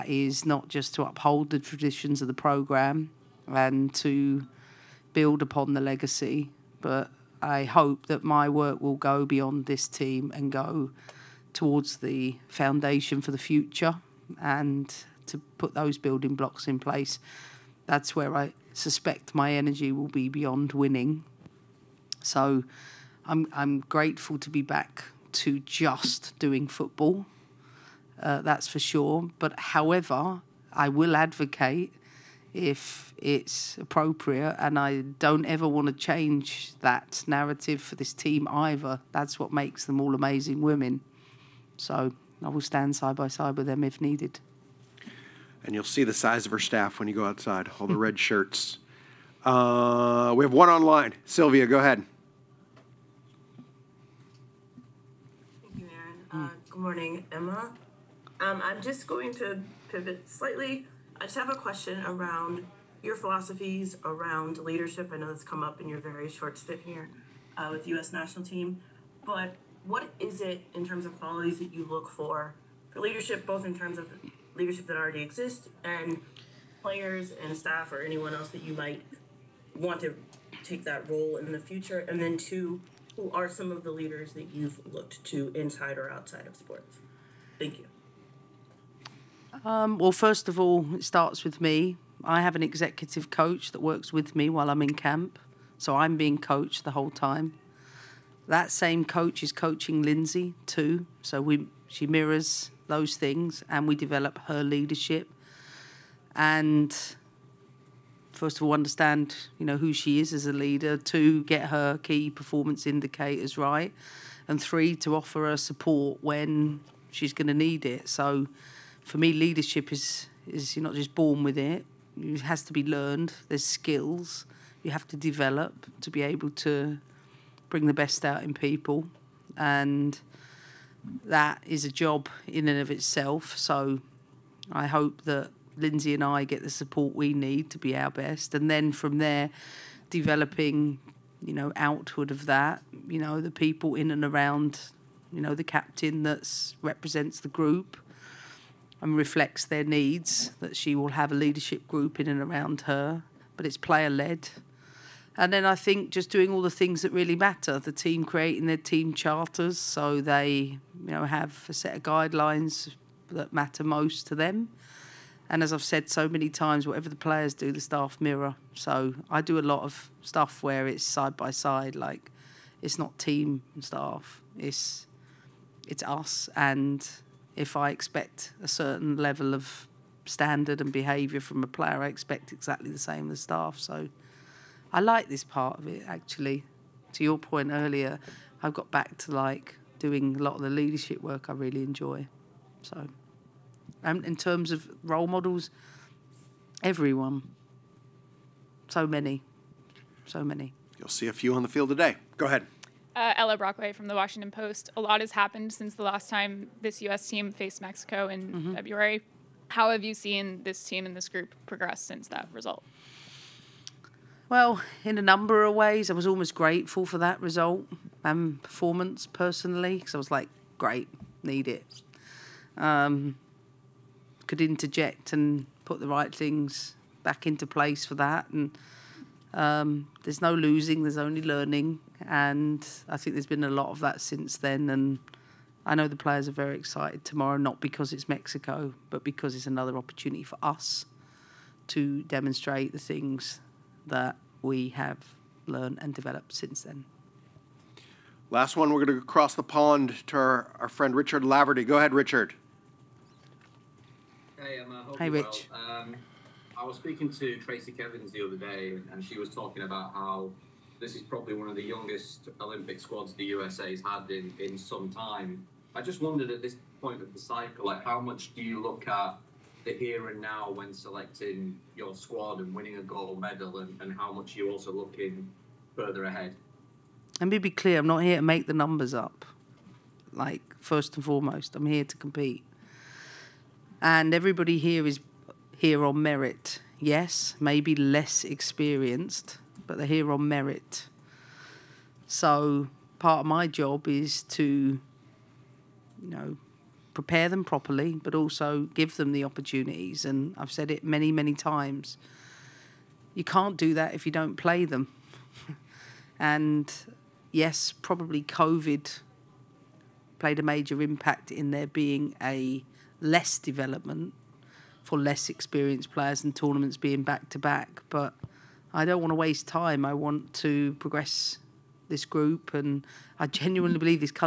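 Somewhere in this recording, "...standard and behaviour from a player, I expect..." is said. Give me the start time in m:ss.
3:00.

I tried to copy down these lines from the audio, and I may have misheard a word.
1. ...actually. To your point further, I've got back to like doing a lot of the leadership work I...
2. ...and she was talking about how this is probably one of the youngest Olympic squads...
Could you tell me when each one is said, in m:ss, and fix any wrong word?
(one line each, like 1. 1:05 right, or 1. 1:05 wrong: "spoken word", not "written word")
1. 3:06 wrong: "earlier", not "further"
2. 4:19 right.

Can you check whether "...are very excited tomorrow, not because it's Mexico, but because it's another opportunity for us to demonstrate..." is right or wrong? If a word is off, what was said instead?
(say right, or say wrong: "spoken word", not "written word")
right.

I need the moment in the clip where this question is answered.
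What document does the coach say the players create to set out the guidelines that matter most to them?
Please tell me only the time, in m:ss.
2:38.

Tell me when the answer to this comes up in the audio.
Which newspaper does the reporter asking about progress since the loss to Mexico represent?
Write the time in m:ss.
3:24.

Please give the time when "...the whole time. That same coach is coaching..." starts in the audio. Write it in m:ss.
1:36.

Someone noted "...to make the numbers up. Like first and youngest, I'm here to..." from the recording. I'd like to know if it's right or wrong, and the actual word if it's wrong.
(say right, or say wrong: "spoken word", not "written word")
wrong: "foremost", not "youngest".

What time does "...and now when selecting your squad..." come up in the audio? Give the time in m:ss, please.
4:30.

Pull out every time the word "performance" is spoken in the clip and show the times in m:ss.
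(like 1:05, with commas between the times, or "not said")
1:52, 3:38.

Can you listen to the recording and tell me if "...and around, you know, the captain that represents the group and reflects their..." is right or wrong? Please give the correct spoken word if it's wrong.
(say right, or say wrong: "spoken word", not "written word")
right.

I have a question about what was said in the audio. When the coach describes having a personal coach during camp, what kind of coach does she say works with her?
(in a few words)
Executive coach.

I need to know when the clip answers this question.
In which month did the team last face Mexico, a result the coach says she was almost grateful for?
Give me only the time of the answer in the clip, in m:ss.
3:28.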